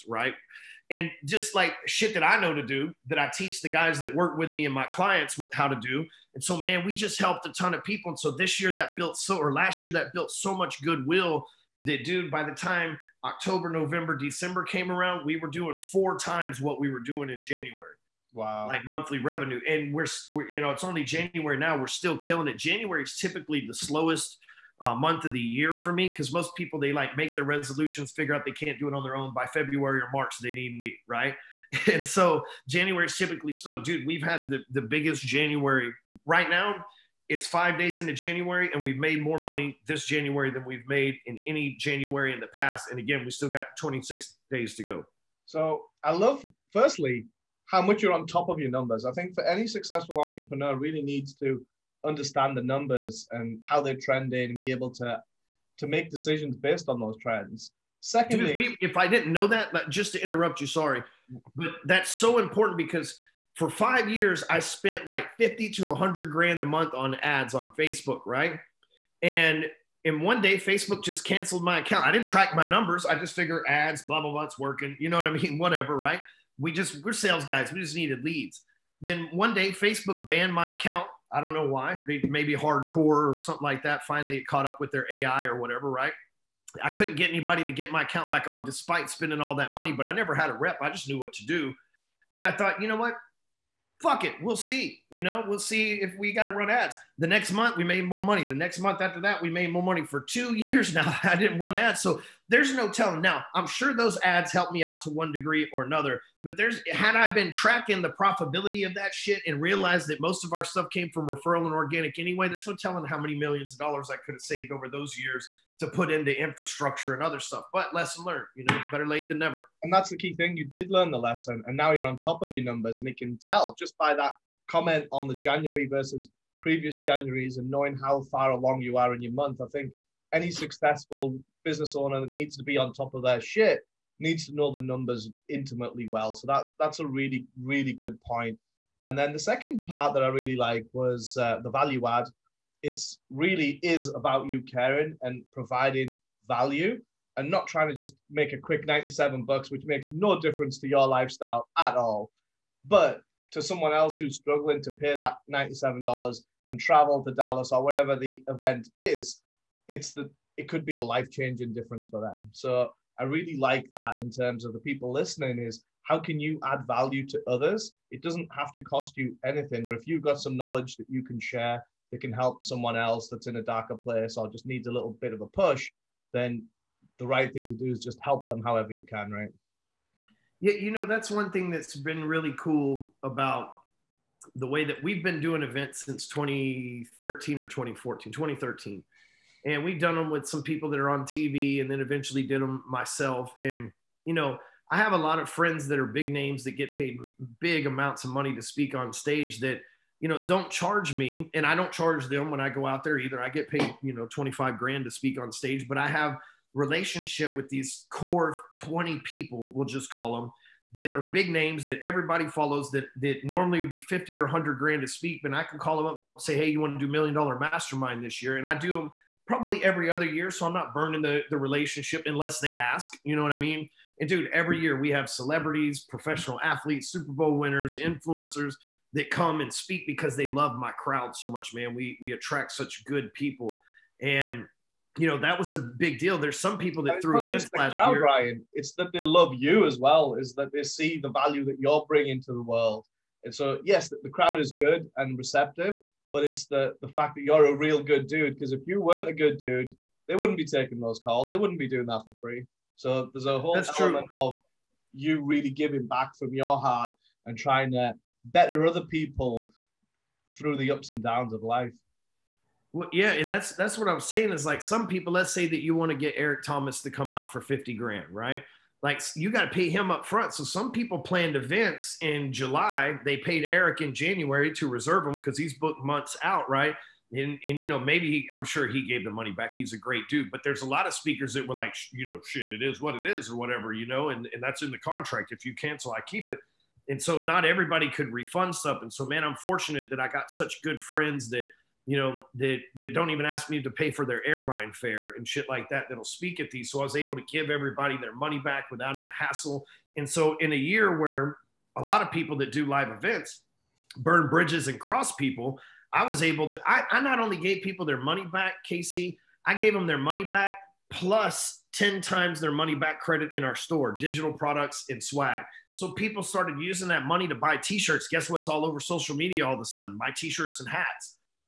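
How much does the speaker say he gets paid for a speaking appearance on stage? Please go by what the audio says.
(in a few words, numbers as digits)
$25,000.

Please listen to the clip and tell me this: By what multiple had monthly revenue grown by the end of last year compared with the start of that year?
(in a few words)
4 times.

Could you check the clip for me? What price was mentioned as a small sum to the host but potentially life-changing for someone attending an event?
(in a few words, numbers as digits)
$97.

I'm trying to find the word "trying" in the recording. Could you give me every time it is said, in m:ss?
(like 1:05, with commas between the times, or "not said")
2:27, 4:17.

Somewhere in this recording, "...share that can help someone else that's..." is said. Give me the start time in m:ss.
2:51.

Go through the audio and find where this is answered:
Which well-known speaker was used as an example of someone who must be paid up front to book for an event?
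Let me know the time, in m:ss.
4:26.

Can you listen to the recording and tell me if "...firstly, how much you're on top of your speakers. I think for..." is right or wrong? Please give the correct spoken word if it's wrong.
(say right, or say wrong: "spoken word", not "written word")
wrong: "numbers", not "speakers".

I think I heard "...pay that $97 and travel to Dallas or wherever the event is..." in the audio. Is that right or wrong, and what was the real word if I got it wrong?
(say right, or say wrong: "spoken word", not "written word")
right.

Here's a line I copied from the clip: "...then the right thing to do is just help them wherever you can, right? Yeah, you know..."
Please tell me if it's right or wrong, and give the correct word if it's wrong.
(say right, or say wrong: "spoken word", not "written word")
wrong: "however", not "wherever".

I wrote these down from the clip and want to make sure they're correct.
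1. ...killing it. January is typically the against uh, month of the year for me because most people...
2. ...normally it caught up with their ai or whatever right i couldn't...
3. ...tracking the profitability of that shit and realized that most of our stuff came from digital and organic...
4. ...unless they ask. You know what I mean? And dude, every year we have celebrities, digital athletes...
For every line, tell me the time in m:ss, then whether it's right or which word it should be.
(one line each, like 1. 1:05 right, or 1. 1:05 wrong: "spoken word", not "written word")
1. 0:22 wrong: "slowest", not "against"
2. 1:24 wrong: "finally", not "normally"
3. 1:47 wrong: "referral", not "digital"
4. 3:42 wrong: "professional", not "digital".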